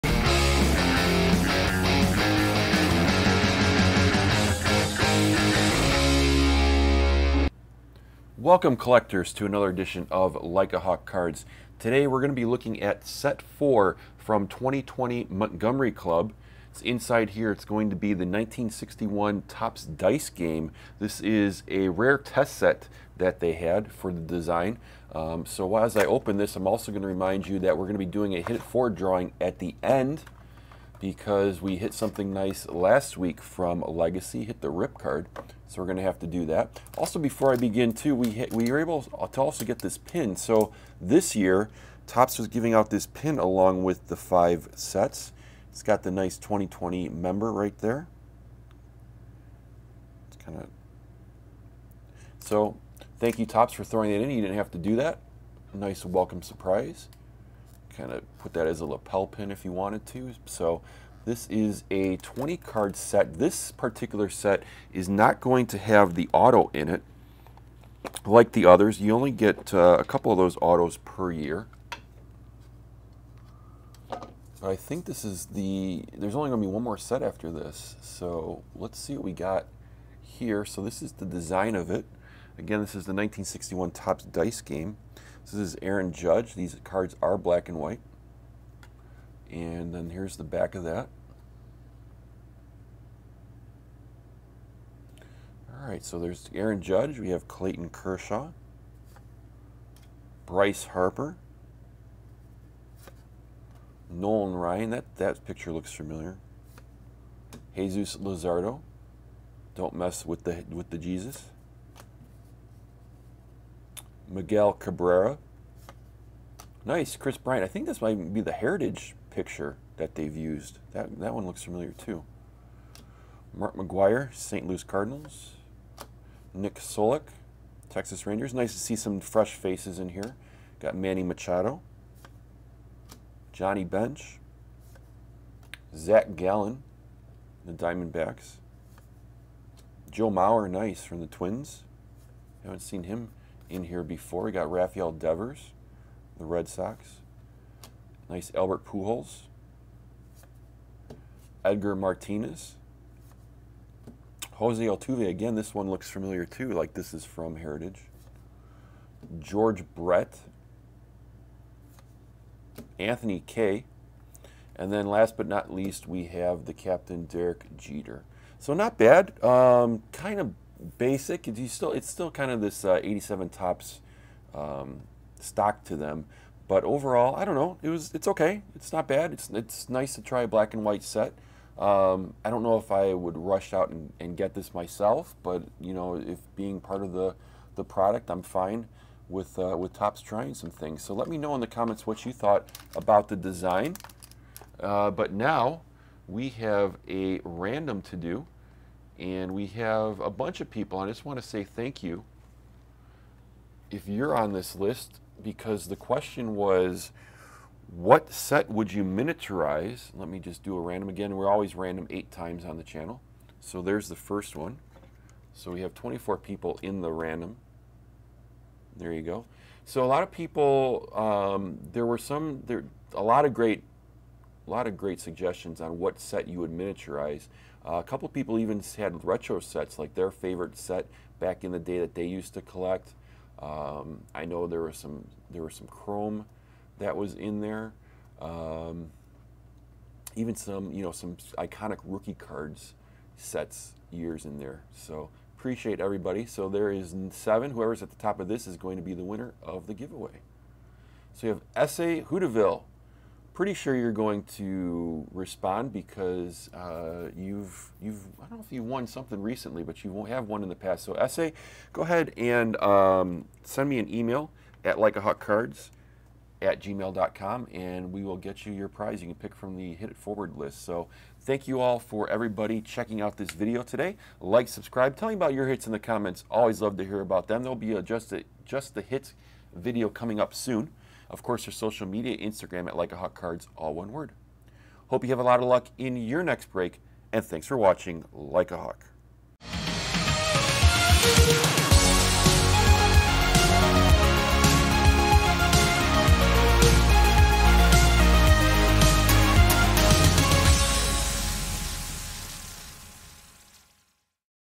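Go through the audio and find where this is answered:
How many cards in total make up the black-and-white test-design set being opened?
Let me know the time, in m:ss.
1:02.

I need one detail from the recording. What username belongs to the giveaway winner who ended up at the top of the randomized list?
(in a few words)
Essay Hooterville.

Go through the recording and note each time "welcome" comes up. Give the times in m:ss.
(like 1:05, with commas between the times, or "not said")
0:08, 0:56.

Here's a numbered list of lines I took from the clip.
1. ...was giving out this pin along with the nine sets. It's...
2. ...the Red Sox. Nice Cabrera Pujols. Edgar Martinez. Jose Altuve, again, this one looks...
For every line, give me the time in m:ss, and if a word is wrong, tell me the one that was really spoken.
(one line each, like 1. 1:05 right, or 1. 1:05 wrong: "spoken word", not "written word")
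1. 0:42 wrong: "five", not "nine"
2. 2:26 wrong: "Albert", not "Cabrera".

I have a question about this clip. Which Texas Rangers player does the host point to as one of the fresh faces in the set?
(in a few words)
Nick Solak.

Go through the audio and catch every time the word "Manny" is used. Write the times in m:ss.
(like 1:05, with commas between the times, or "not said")
2:10.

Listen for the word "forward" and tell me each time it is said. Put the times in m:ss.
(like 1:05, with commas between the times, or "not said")
0:28, 4:30.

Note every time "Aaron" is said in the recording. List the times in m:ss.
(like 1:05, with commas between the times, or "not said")
1:25, 1:36.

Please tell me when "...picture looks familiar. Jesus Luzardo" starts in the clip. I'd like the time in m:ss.
1:45.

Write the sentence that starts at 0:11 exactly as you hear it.
Today we're going to be looking at set 4 from 2020 Montgomery Club.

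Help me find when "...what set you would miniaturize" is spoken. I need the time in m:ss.
3:45.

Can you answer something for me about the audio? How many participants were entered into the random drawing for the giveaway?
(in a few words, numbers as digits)
24.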